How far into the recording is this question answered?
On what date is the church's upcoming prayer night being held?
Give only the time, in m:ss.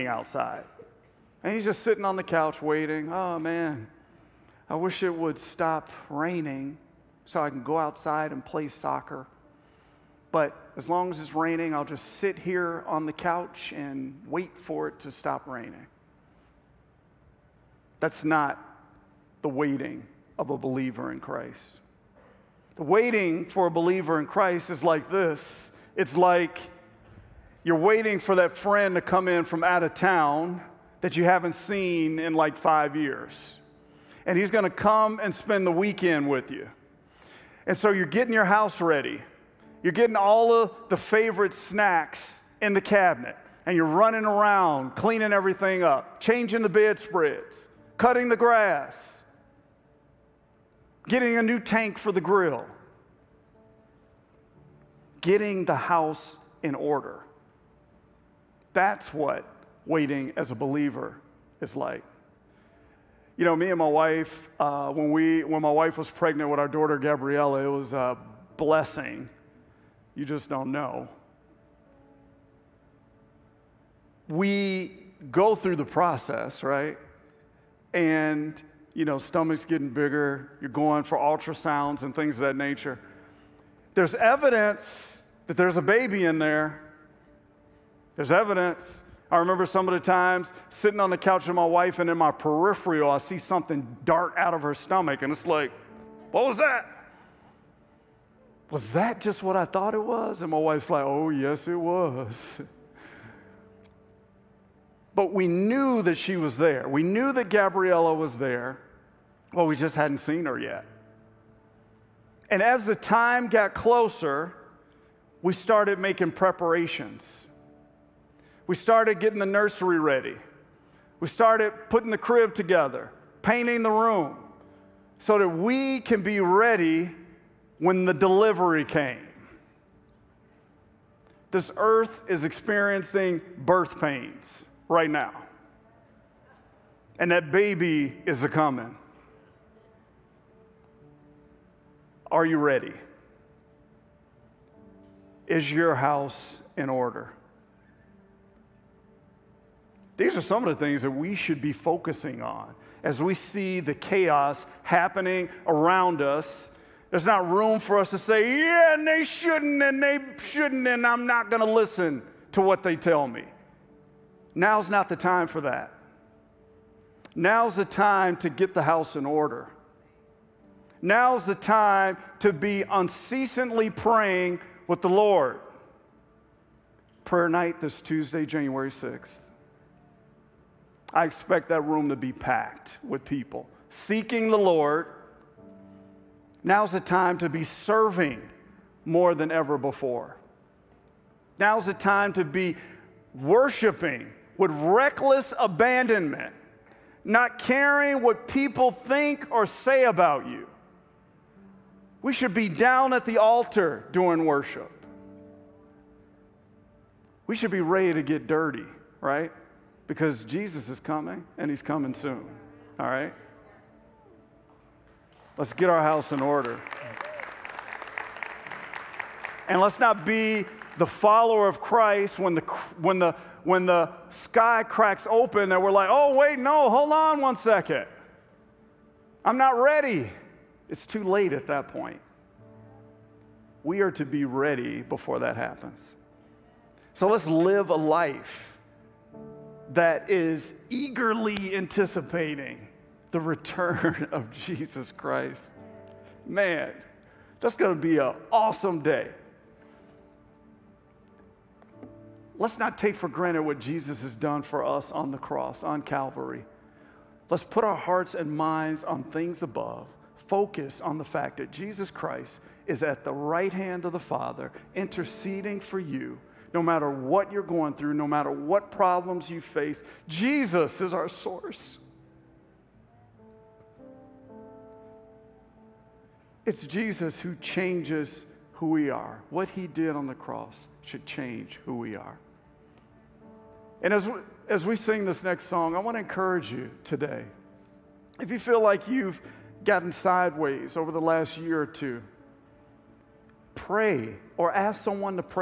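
2:58.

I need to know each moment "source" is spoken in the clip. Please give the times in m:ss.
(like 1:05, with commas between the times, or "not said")
4:31.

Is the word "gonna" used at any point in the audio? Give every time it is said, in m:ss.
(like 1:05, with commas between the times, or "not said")
0:34.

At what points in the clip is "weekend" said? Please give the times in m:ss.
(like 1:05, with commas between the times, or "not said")
0:35.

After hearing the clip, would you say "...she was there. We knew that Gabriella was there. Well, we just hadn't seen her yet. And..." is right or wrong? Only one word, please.
right.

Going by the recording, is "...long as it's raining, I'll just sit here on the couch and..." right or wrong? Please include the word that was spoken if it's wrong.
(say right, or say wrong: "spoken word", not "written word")
right.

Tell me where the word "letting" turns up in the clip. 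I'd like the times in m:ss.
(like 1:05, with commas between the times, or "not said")
not said.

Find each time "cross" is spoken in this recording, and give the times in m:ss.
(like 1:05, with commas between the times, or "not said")
4:15, 4:40.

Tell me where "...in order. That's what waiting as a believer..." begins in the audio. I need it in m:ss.
0:56.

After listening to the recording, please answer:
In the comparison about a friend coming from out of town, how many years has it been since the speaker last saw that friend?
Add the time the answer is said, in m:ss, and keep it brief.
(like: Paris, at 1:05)
5, at 0:32.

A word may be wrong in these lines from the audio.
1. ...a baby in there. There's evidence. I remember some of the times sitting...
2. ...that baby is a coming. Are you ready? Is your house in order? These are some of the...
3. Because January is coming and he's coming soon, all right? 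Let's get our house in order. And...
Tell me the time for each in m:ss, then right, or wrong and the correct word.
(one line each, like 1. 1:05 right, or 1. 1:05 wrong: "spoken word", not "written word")
1. 1:25 right
2. 2:17 right
3. 3:30 wrong: "Jesus", not "January".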